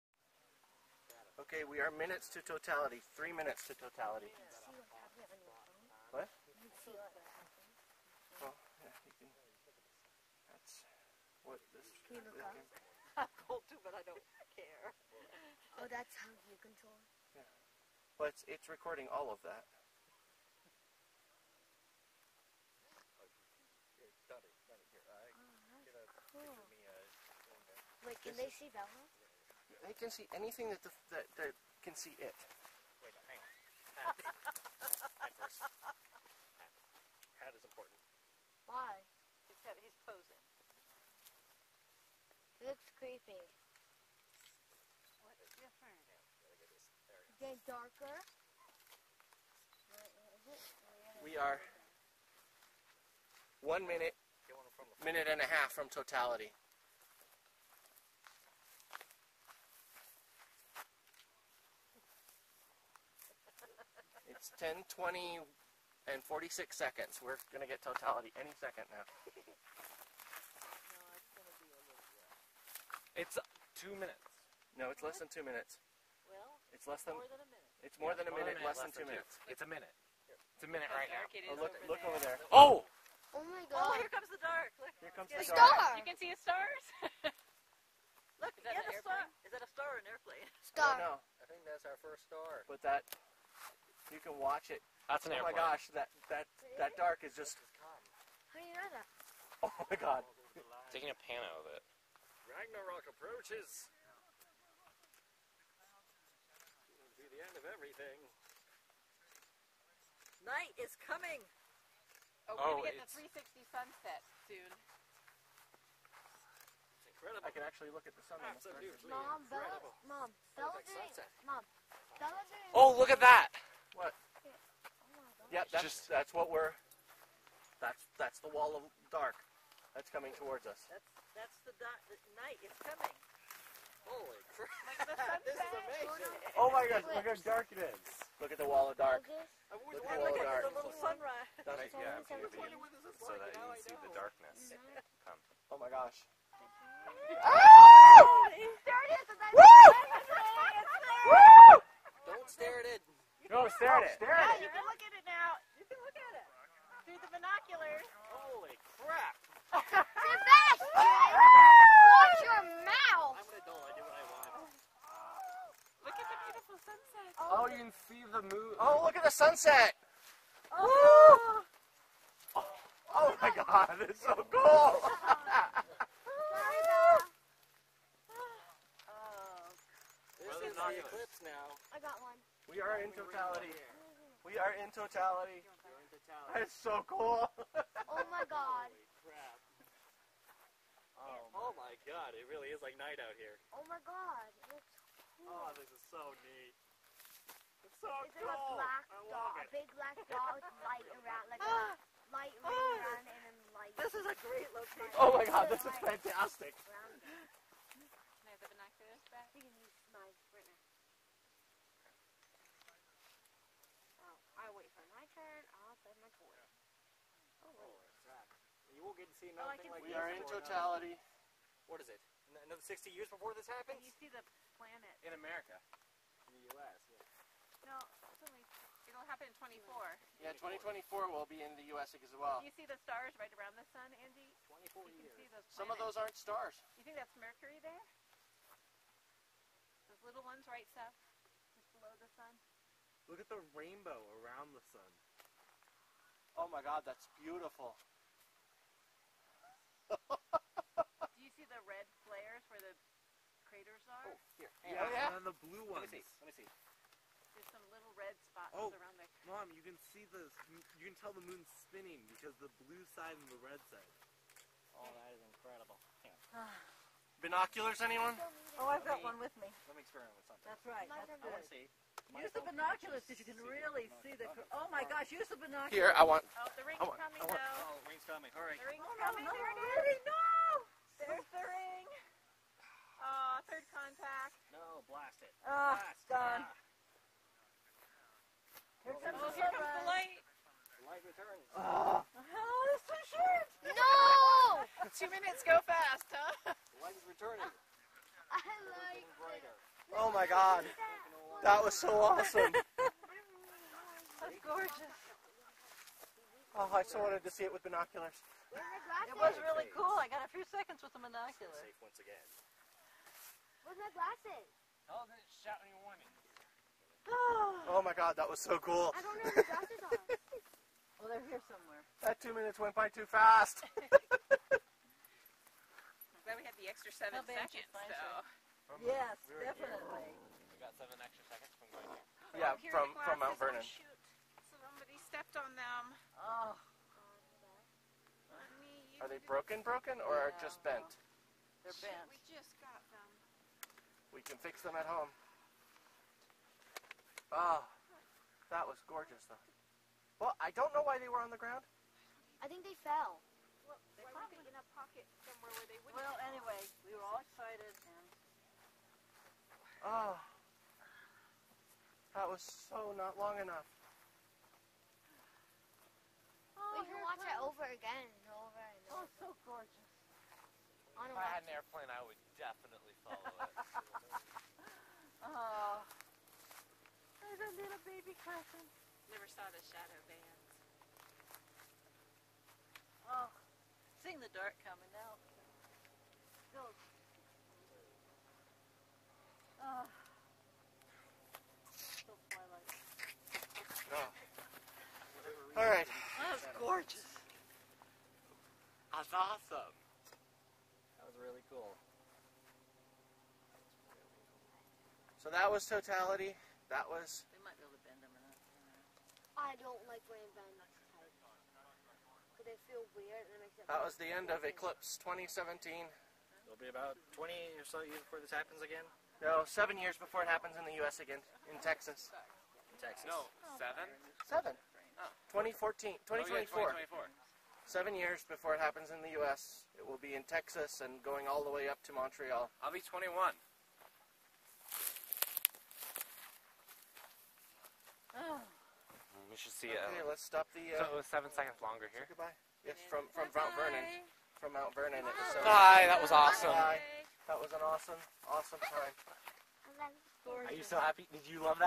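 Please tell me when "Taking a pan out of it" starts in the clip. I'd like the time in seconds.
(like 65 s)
100 s.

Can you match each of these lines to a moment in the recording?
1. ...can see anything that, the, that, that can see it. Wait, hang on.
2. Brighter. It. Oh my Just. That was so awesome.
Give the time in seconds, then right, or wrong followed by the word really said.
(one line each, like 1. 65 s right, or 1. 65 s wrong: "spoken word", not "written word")
1. 29 s right
2. 299 s wrong: "God", not "Just".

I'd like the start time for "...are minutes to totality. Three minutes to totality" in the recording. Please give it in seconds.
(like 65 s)
1 s.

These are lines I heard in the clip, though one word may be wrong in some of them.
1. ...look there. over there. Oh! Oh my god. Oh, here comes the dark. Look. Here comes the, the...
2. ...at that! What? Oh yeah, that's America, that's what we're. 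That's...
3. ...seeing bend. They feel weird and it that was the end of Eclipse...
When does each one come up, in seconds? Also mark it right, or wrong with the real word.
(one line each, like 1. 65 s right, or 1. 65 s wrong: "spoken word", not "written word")
1. 81 s right
2. 123 s wrong: "Just", not "America"
3. 410 s wrong: "laying", not "seeing".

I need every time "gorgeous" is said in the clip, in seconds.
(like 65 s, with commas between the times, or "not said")
304 s, 349 s, 369 s, 397 s.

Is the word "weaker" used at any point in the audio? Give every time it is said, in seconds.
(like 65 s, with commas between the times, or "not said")
not said.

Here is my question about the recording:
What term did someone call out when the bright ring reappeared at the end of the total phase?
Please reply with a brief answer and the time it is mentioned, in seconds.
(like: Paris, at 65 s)
third contact, at 283 s.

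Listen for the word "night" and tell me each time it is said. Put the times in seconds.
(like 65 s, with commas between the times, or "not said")
110 s, 132 s, 192 s.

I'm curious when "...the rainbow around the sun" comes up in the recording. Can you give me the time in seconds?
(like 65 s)
243 s.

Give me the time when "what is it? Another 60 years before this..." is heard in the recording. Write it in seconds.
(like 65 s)
221 s.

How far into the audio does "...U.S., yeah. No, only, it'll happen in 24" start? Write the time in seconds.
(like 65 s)
226 s.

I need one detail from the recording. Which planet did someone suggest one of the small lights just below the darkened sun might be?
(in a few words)
Mercury.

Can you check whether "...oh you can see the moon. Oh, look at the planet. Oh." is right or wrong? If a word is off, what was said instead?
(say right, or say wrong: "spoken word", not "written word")
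wrong: "sunset", not "planet".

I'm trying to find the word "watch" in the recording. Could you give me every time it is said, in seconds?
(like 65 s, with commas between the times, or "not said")
94 s, 159 s, 367 s.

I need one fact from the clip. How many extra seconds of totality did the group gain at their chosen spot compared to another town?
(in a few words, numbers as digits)
7.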